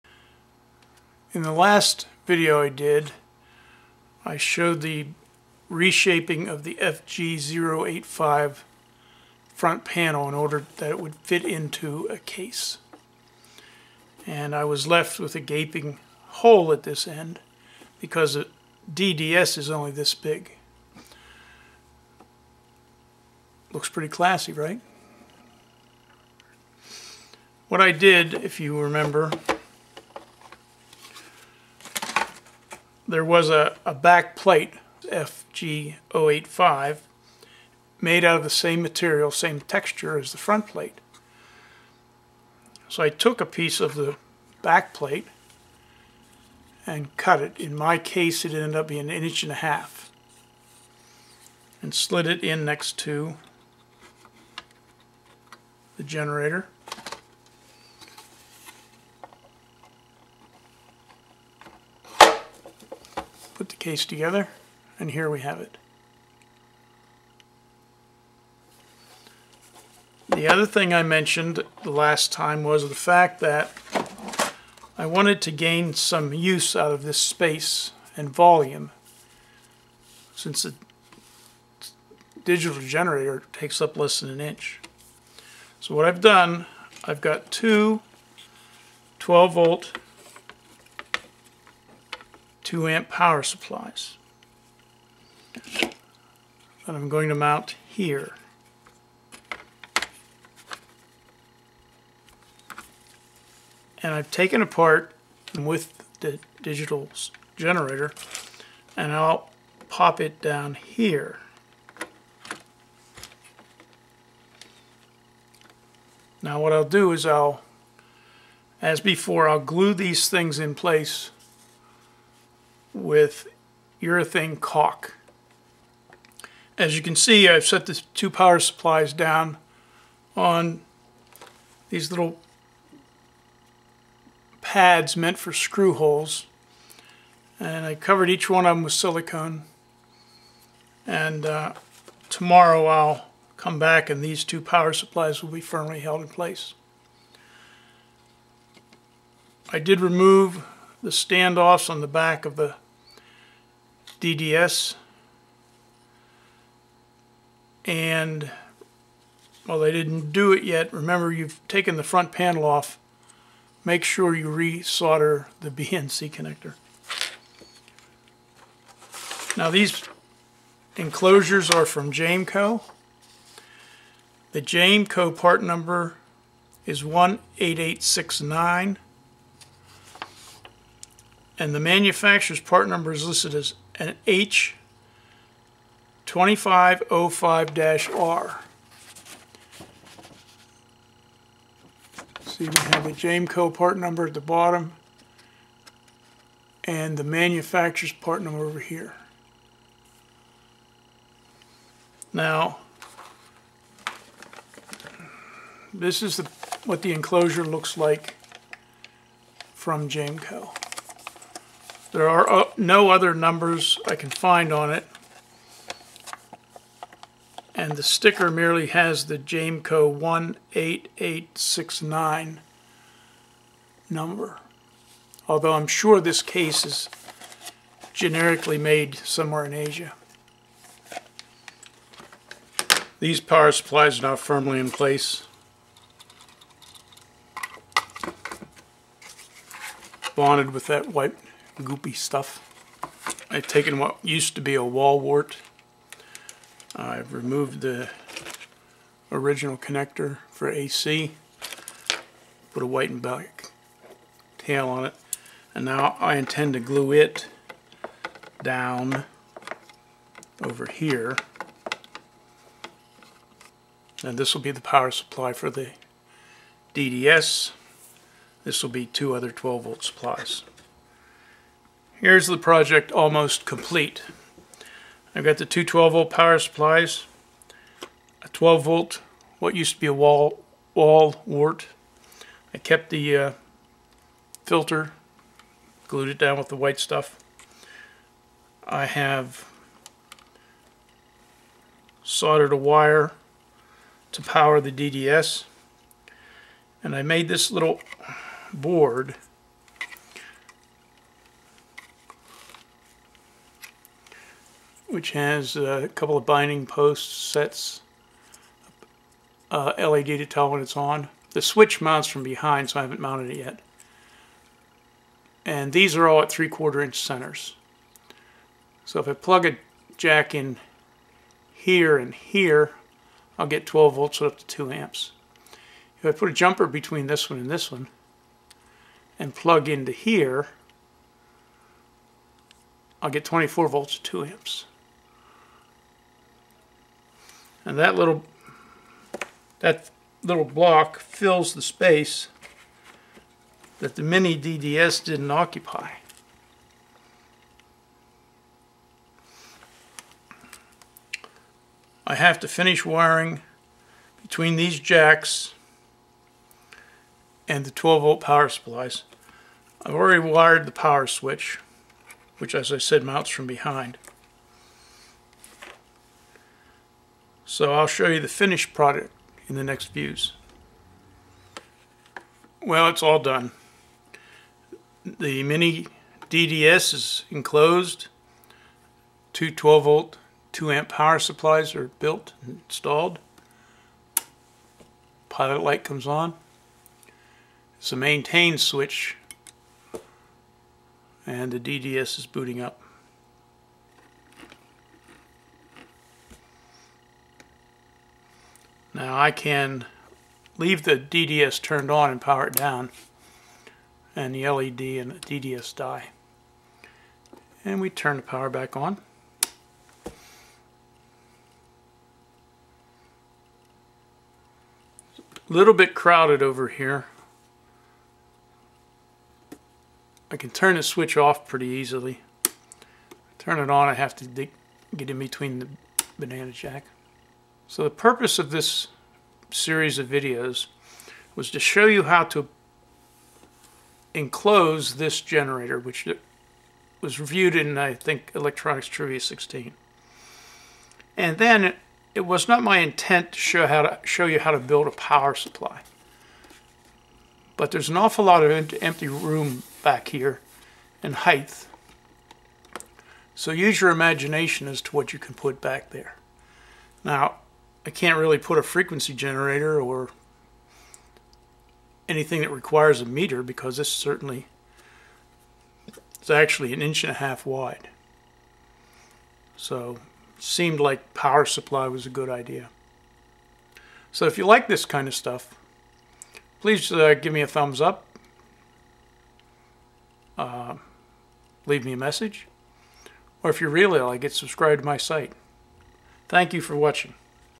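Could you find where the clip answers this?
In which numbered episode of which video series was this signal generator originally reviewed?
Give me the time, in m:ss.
7:18.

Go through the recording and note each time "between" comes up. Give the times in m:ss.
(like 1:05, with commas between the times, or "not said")
5:26, 5:54, 7:05.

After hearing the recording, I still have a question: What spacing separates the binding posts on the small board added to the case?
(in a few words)
3/4 inch centers.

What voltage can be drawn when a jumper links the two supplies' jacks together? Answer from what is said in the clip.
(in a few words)
24 volts.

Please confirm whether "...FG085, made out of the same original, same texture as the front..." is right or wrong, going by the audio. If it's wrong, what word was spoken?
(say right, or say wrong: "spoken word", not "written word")
wrong: "material", not "original".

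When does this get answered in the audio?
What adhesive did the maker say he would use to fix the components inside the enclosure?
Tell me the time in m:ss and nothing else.
2:04.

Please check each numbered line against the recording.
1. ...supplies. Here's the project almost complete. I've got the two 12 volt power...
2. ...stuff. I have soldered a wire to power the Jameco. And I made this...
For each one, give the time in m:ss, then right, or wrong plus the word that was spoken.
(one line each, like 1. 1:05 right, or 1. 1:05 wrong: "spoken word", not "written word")
1. 4:30 right
2. 4:46 wrong: "DDS", not "Jameco".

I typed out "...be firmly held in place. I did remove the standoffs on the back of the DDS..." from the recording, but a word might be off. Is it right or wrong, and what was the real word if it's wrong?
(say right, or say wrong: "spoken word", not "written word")
right.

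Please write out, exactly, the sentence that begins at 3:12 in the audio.
See, we have the Jameco part number at the bottom and the manufacturer's part number over here.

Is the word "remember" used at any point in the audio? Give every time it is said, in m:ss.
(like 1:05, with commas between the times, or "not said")
0:28, 2:40.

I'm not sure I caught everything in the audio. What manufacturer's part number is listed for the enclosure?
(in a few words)
H2505-R.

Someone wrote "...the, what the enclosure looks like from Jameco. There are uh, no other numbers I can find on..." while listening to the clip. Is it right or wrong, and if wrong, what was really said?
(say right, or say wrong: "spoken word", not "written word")
right.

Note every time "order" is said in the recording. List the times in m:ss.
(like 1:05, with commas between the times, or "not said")
0:10.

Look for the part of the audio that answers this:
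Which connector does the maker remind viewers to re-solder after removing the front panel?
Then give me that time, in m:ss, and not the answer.
2:45.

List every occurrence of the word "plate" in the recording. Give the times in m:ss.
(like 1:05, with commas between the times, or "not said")
0:34, 0:40, 0:44.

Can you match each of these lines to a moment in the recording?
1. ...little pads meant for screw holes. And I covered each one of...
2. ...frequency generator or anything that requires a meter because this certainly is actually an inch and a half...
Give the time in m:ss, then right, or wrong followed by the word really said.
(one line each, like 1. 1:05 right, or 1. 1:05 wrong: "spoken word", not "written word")
1. 2:12 right
2. 7:38 right.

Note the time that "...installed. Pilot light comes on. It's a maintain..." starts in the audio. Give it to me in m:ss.
6:22.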